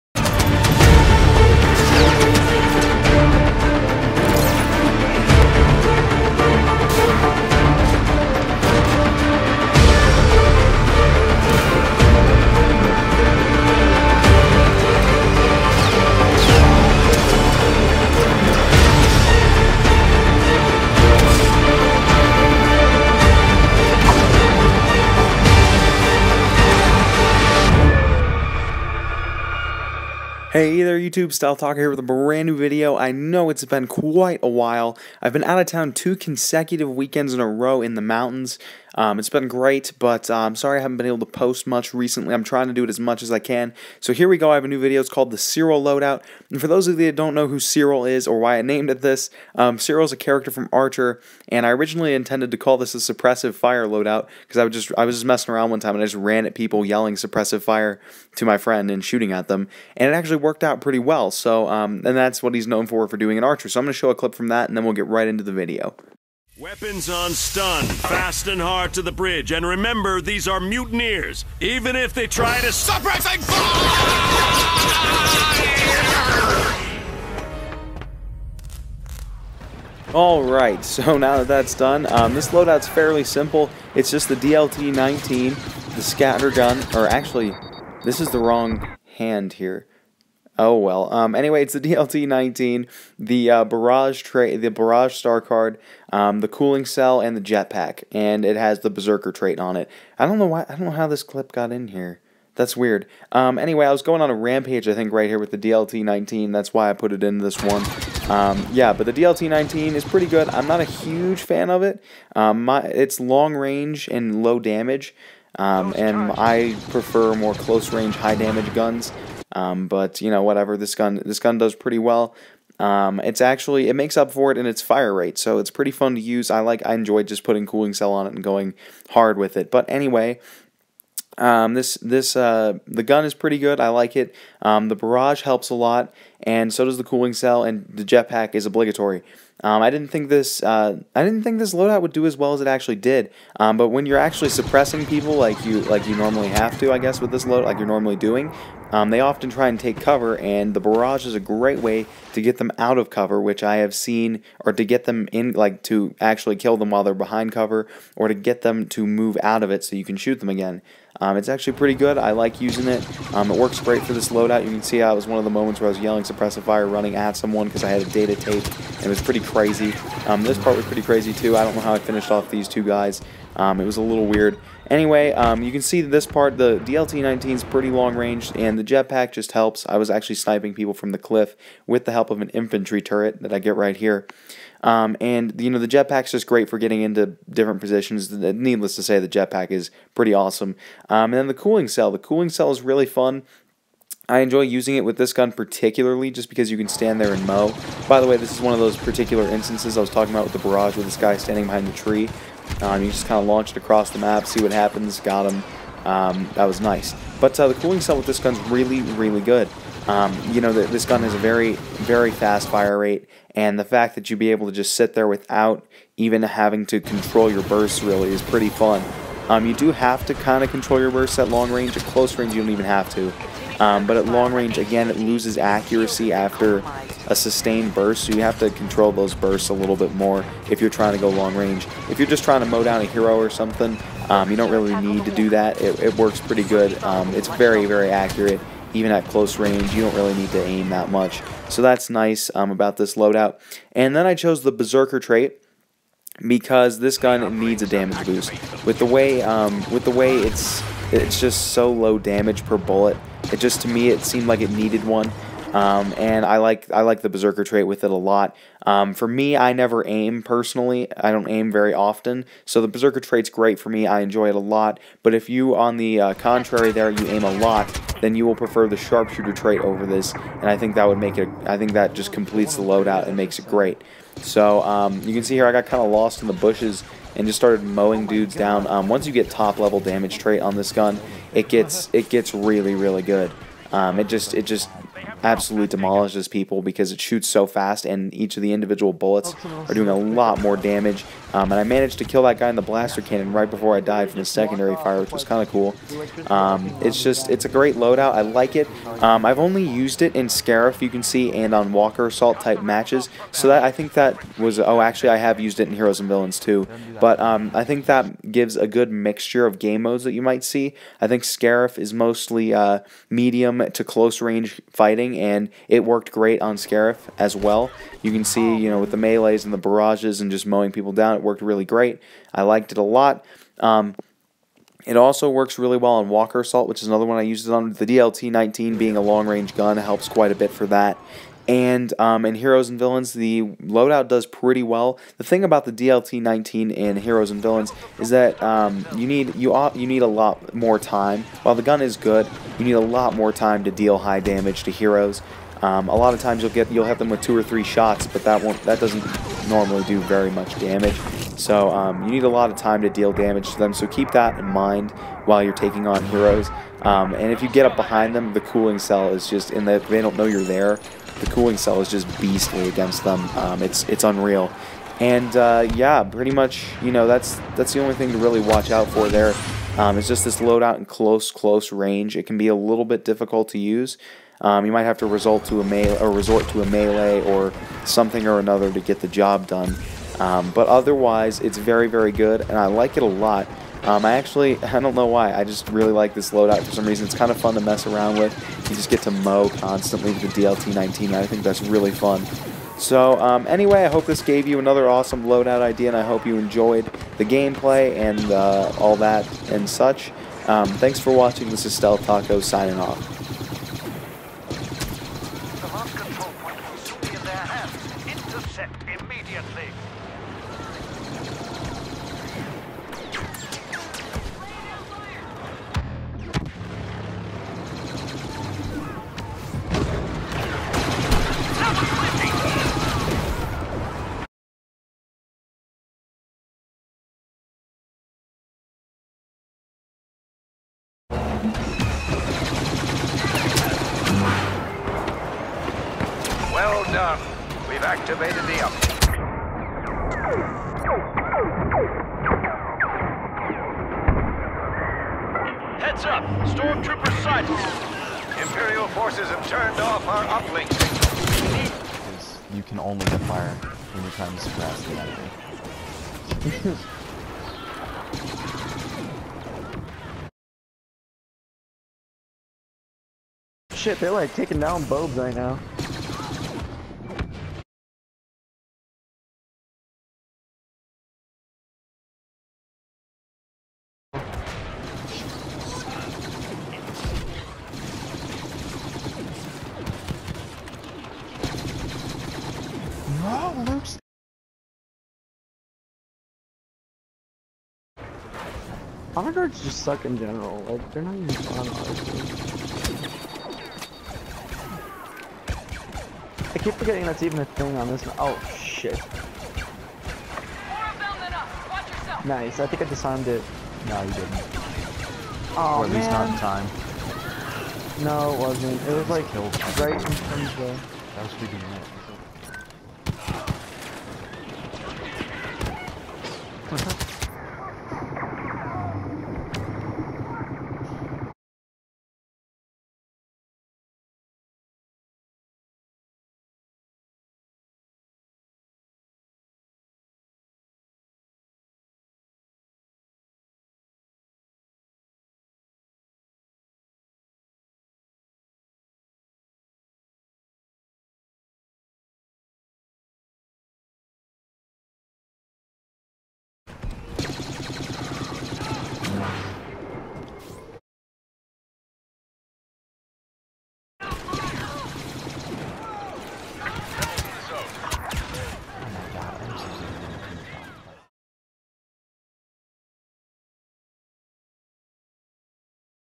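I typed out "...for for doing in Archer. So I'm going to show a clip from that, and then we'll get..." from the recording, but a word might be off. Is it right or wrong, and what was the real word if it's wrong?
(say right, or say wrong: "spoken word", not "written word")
right.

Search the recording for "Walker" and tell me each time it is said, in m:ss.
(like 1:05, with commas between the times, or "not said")
5:01, 5:26.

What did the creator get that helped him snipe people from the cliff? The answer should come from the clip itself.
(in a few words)
infantry turret.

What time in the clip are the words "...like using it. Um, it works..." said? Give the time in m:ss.
2:42.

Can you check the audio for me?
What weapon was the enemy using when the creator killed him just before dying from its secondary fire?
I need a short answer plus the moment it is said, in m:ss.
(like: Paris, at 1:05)
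blaster cannon, at 4:52.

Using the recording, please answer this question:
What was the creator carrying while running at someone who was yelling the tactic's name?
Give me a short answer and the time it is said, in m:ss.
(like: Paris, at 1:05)
a data tape, at 2:48.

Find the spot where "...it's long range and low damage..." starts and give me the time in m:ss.
1:52.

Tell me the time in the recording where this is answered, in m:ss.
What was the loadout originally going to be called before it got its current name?
0:52.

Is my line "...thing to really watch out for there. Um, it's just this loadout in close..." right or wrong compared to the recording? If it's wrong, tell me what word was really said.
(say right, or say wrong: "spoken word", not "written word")
right.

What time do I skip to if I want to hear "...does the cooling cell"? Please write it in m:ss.
2:16.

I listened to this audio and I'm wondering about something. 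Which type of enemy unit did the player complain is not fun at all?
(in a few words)
Honor guards.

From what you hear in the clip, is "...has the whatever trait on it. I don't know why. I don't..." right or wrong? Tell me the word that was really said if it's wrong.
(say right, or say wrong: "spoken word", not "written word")
wrong: "berserker", not "whatever".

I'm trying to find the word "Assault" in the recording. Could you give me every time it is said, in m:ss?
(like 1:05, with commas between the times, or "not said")
5:02, 5:26.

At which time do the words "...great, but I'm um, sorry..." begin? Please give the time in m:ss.
0:39.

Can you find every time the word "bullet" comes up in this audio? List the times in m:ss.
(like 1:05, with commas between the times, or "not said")
4:12, 4:49.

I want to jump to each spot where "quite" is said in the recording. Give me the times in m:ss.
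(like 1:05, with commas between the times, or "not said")
0:33, 5:30.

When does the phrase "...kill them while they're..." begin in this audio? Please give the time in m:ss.
2:36.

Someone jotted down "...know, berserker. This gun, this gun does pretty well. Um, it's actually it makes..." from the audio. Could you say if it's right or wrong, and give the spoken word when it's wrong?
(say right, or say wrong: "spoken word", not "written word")
wrong: "whatever", not "berserker".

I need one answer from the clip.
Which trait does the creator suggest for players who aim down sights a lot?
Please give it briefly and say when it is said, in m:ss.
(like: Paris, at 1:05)
sharpshooter, at 4:28.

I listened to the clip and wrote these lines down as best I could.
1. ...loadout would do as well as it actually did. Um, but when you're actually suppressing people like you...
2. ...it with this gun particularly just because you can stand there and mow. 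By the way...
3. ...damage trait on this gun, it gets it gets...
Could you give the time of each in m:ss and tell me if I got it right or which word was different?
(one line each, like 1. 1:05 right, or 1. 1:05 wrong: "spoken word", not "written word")
1. 2:21 right
2. 3:14 right
3. 4:39 right.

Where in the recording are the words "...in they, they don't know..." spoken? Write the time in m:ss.
5:59.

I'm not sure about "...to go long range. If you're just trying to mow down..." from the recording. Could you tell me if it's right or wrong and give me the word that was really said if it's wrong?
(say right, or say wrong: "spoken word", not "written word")
right.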